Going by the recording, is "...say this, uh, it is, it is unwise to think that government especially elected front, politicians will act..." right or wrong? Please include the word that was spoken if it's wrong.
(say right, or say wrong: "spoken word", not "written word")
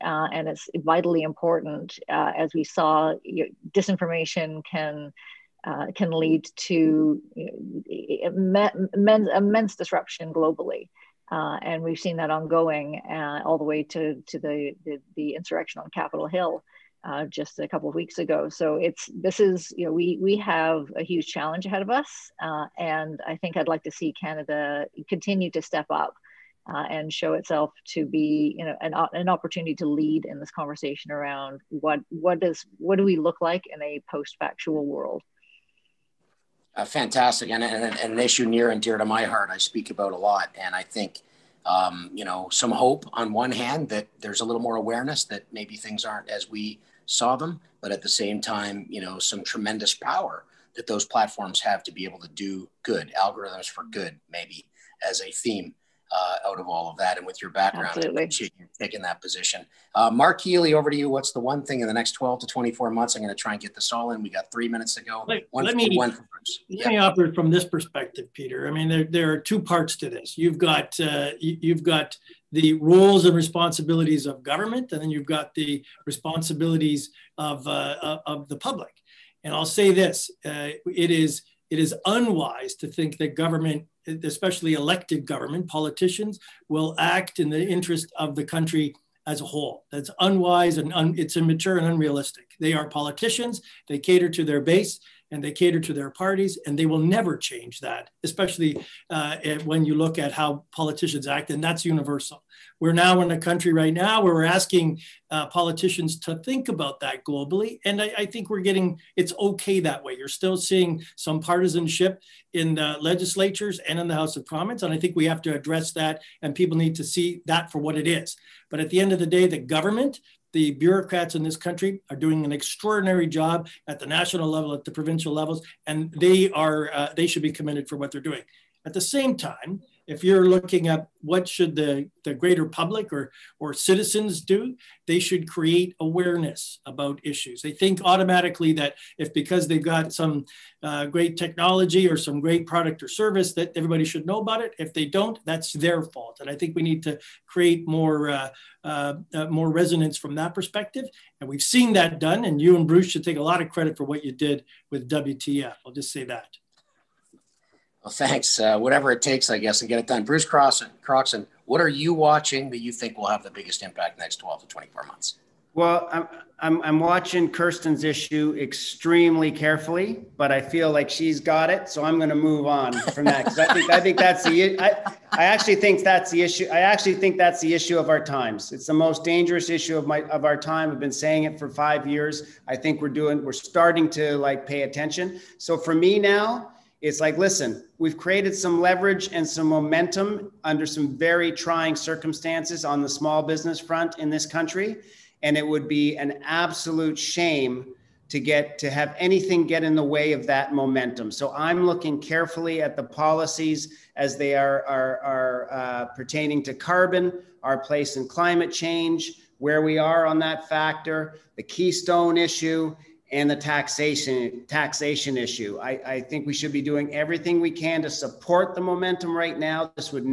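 wrong: "government", not "front".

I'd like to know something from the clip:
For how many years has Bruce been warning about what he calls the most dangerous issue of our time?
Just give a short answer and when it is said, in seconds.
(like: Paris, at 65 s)
5, at 181 s.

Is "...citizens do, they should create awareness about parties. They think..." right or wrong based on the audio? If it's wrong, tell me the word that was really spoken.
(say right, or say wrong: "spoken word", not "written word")
wrong: "issues", not "parties".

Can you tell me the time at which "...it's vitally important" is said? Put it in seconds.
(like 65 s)
0 s.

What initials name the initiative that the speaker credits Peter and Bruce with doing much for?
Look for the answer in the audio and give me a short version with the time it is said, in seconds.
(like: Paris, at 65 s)
WTF, at 155 s.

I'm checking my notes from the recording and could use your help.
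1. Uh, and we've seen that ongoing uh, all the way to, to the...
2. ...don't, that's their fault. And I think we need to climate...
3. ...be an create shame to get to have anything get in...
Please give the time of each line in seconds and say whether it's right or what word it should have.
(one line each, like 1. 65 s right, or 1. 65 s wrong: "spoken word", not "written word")
1. 11 s right
2. 145 s wrong: "create", not "climate"
3. 195 s wrong: "absolute", not "create".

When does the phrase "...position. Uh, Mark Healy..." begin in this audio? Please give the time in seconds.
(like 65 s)
59 s.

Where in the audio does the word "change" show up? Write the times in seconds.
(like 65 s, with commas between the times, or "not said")
97 s, 208 s.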